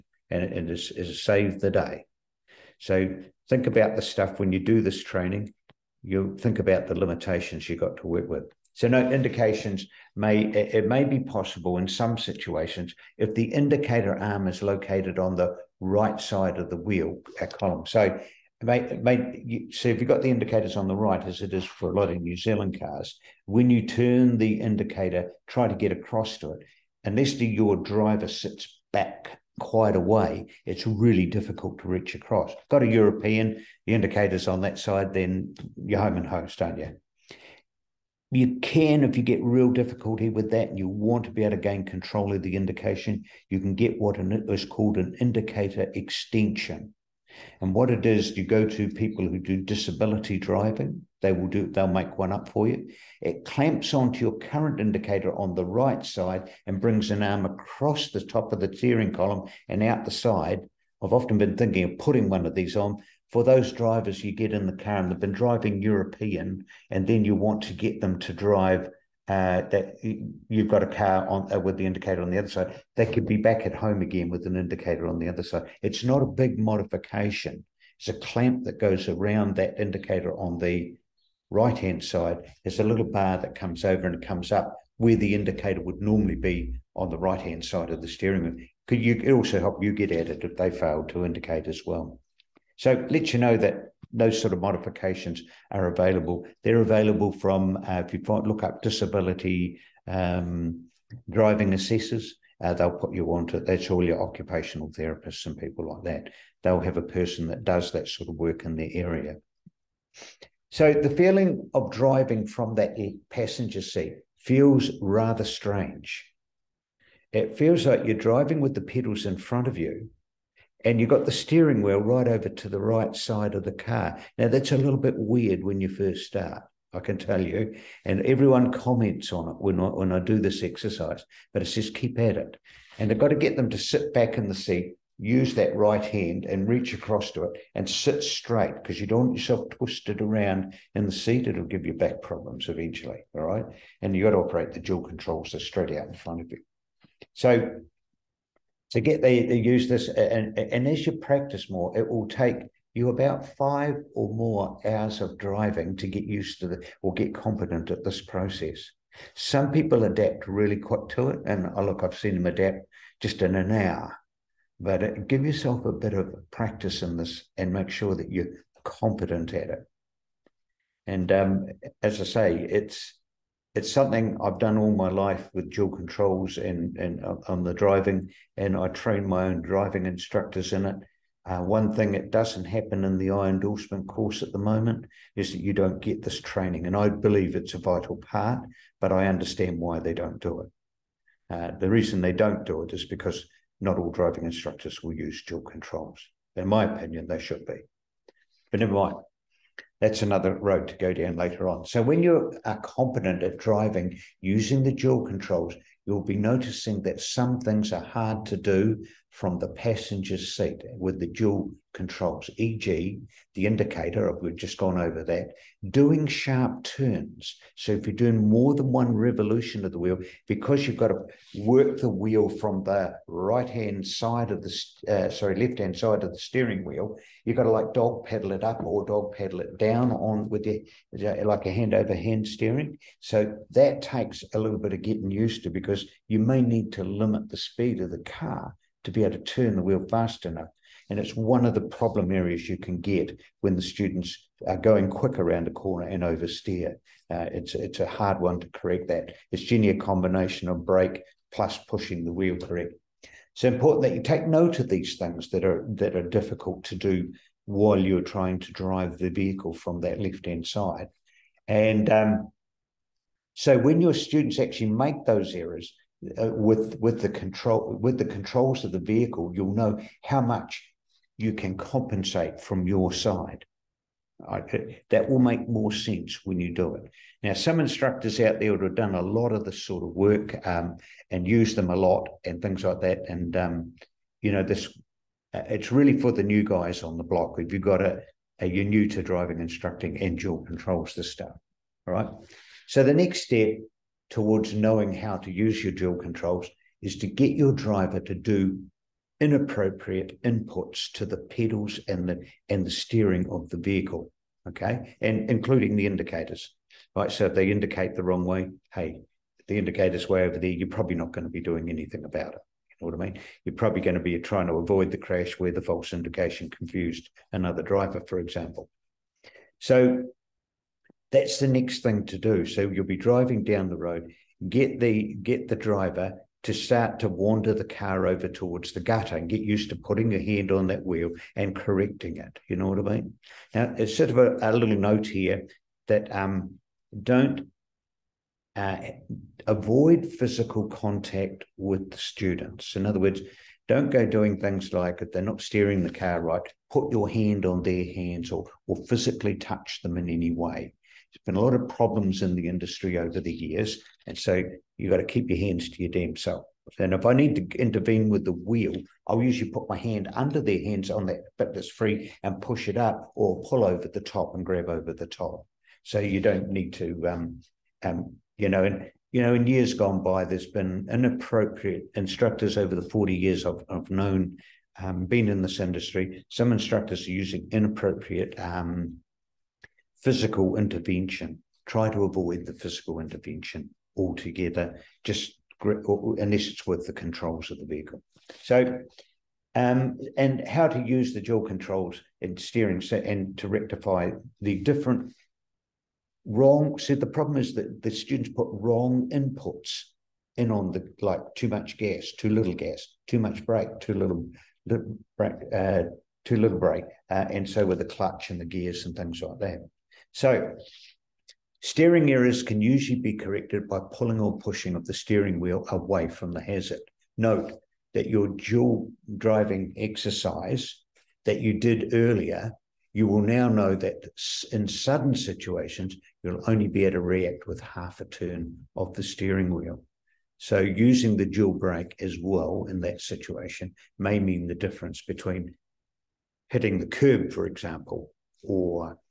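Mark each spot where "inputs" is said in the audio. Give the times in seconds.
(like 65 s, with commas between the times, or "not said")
300 s, 399 s.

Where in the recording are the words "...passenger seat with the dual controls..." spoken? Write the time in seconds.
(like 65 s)
209 s.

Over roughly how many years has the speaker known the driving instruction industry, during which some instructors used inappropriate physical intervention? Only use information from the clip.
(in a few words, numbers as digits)
40 years.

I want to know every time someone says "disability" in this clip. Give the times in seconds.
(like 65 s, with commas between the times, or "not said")
49 s, 98 s.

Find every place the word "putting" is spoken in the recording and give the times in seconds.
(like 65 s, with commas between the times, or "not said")
61 s, 329 s.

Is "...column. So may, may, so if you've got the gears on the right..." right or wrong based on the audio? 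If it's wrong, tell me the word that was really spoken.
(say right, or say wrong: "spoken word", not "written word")
wrong: "indicators", not "gears".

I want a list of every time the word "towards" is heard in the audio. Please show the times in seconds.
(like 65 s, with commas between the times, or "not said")
294 s, 328 s.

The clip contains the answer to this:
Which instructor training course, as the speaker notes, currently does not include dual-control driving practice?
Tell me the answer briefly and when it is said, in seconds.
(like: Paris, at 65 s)
I endorsement course, at 183 s.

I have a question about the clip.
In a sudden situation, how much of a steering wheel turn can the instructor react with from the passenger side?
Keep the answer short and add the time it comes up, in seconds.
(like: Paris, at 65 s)
half a turn, at 427 s.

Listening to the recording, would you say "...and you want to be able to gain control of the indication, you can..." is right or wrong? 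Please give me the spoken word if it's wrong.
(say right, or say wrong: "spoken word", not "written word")
right.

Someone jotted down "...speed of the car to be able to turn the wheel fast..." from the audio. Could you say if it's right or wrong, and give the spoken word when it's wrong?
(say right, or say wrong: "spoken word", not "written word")
right.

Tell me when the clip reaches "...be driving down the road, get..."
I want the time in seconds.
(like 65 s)
323 s.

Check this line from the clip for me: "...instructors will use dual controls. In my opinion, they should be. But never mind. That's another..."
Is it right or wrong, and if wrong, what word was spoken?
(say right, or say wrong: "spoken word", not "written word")
right.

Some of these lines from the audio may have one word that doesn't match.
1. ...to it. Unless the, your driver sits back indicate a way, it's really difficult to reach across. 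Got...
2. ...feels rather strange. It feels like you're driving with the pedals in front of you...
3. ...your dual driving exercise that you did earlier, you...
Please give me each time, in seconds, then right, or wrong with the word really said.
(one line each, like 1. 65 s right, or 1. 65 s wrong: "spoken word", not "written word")
1. 26 s wrong: "quite", not "indicate"
2. 114 s right
3. 418 s right.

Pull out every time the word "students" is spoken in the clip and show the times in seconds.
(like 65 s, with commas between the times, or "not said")
243 s, 264 s, 342 s, 398 s.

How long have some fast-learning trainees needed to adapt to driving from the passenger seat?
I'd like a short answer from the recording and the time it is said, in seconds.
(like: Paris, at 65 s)
an hour, at 163 s.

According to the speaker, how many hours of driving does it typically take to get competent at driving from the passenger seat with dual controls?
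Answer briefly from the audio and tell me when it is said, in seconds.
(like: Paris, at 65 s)
5, at 153 s.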